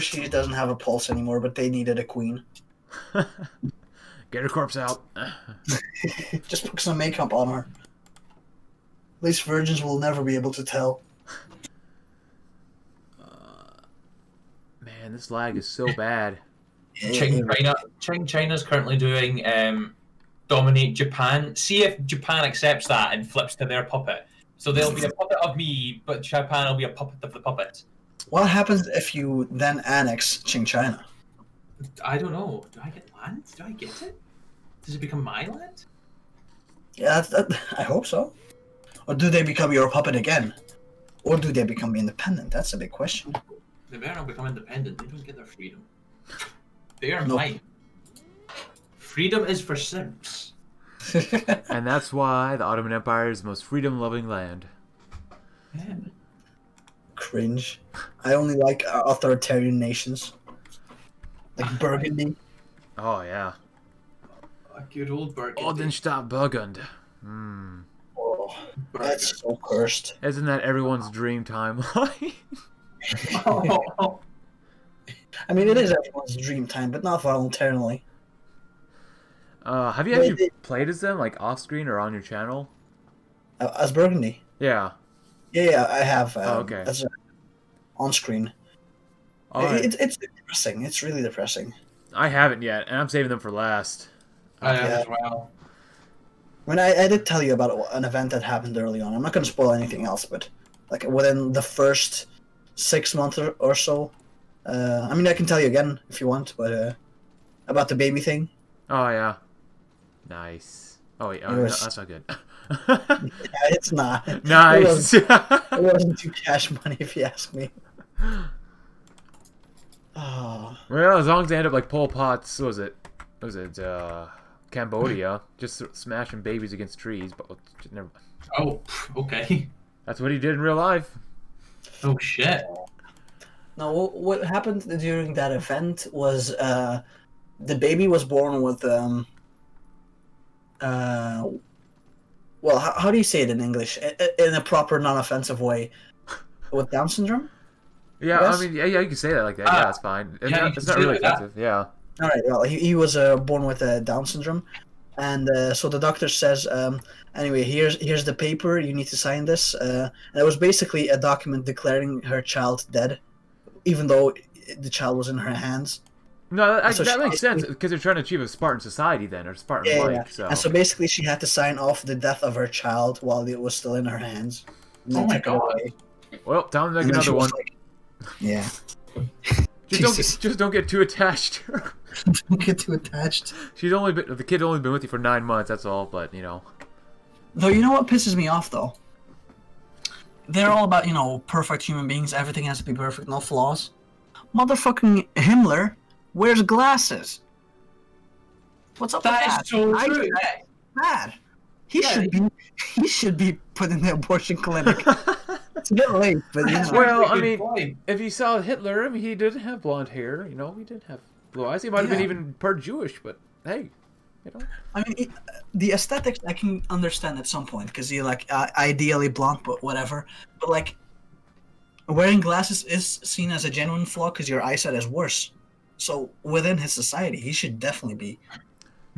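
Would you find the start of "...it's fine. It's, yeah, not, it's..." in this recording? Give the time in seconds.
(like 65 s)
149 s.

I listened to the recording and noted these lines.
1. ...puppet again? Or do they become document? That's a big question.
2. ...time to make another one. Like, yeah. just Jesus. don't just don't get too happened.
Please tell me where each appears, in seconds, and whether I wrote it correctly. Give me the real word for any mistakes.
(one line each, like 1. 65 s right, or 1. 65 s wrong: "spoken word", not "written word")
1. 39 s wrong: "independent", not "document"
2. 176 s wrong: "attached", not "happened".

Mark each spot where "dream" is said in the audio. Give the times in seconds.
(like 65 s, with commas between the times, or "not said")
71 s, 76 s.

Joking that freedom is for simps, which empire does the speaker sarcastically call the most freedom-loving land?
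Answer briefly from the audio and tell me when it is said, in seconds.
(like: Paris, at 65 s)
Ottoman Empire, at 52 s.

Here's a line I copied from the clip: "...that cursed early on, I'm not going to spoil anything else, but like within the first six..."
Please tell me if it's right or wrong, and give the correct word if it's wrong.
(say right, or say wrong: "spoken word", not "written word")
wrong: "happened", not "cursed".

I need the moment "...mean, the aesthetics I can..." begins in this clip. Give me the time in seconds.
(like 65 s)
215 s.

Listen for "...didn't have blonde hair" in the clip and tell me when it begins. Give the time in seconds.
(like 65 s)
209 s.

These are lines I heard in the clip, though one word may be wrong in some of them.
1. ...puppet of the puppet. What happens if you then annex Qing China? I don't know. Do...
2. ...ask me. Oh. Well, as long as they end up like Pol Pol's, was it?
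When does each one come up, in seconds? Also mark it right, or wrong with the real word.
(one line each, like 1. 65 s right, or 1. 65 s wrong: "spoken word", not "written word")
1. 26 s right
2. 117 s wrong: "Pot", not "Pol".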